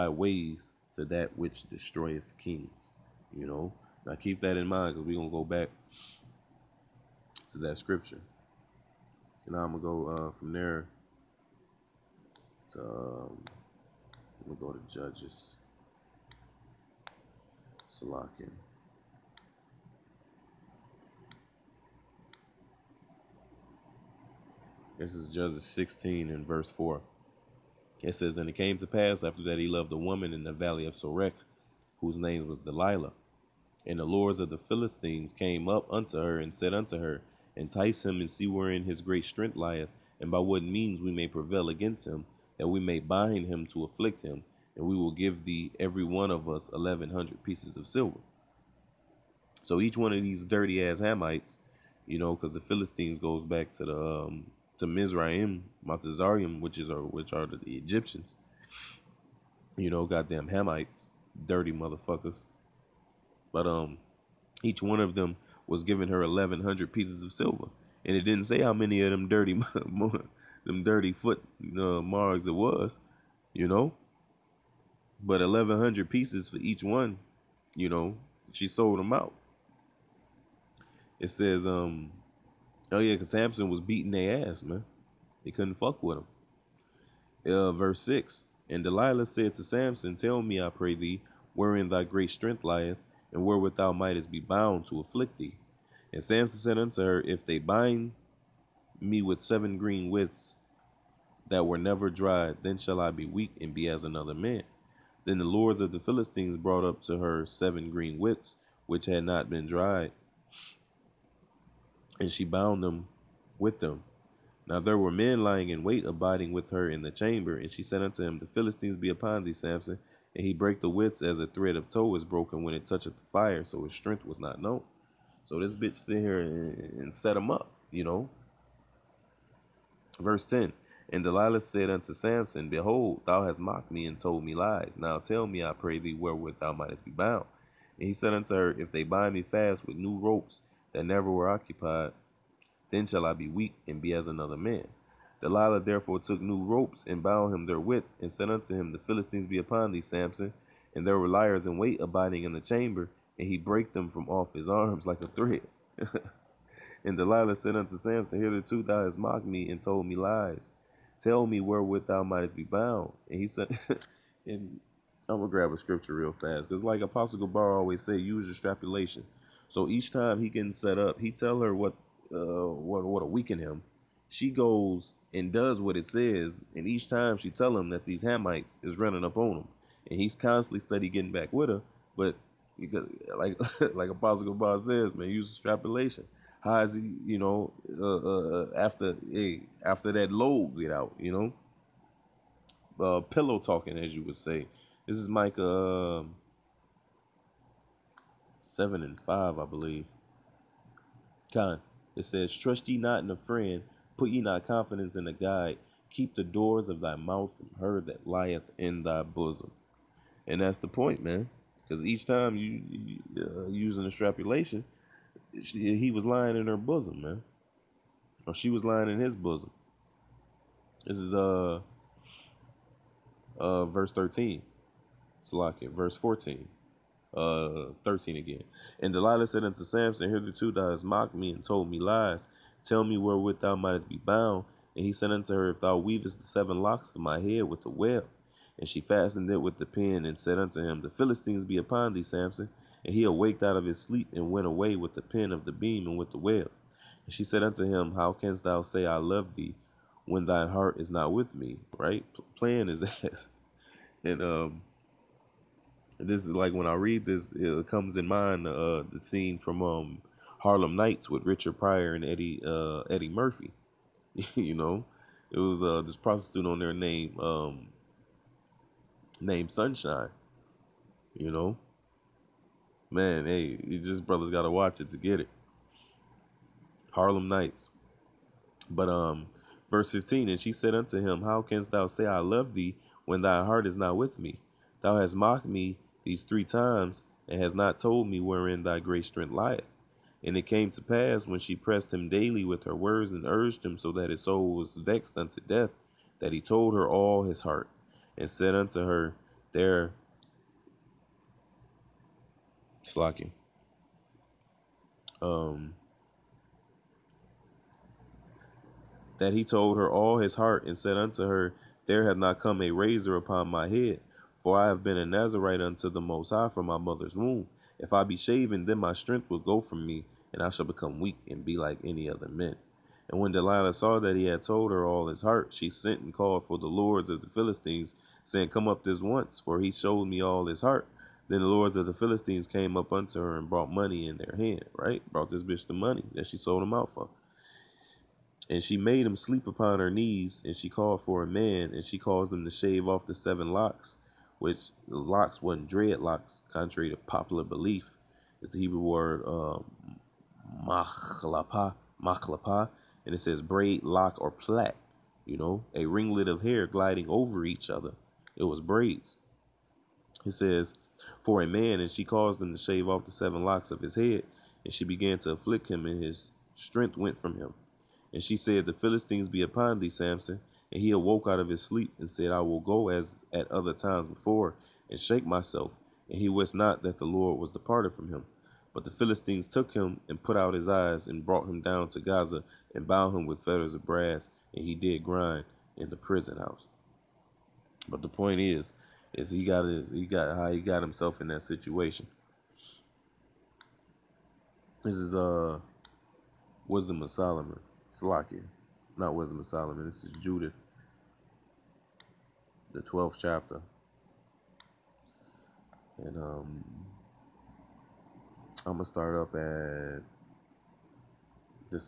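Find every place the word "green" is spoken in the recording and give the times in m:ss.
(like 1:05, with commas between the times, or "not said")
1:39, 1:47.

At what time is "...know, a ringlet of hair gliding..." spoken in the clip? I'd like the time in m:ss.
5:55.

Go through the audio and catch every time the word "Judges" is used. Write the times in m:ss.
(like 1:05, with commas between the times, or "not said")
0:14, 0:25.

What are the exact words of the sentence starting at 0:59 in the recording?
You know, goddamn Hamites, dirty motherfuckers.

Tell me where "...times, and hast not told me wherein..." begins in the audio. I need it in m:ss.
4:46.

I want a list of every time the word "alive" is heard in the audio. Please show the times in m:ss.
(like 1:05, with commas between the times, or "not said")
not said.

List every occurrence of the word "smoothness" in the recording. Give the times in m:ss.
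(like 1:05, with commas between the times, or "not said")
not said.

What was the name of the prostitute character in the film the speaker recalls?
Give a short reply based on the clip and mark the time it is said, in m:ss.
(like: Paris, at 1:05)
Sunshine, at 4:29.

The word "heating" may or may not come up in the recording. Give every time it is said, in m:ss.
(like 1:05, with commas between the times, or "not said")
not said.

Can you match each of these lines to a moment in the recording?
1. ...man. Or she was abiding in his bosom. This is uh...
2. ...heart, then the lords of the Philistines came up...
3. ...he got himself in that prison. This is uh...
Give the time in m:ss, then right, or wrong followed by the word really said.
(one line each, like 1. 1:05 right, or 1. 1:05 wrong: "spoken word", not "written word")
1. 3:37 wrong: "lying", not "abiding"
2. 5:30 right
3. 6:30 wrong: "situation", not "prison".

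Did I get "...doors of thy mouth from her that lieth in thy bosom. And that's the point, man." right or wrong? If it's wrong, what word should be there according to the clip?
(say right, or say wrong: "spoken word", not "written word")
right.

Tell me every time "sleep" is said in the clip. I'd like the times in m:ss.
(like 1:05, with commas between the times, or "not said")
4:03, 5:39, 6:11.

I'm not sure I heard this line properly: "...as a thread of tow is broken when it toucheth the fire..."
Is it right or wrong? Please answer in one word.
right.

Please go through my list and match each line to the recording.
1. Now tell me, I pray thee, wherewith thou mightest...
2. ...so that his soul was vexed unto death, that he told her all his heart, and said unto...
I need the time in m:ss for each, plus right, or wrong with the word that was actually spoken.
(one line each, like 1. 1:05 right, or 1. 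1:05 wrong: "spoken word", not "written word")
1. 2:14 right
2. 4:53 right.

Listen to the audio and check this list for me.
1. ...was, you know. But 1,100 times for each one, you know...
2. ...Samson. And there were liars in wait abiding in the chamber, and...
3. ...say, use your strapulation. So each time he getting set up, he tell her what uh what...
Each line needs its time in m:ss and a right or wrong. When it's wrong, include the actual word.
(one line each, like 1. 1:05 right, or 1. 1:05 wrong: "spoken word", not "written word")
1. 1:12 wrong: "pieces", not "times"
2. 2:30 right
3. 2:48 right.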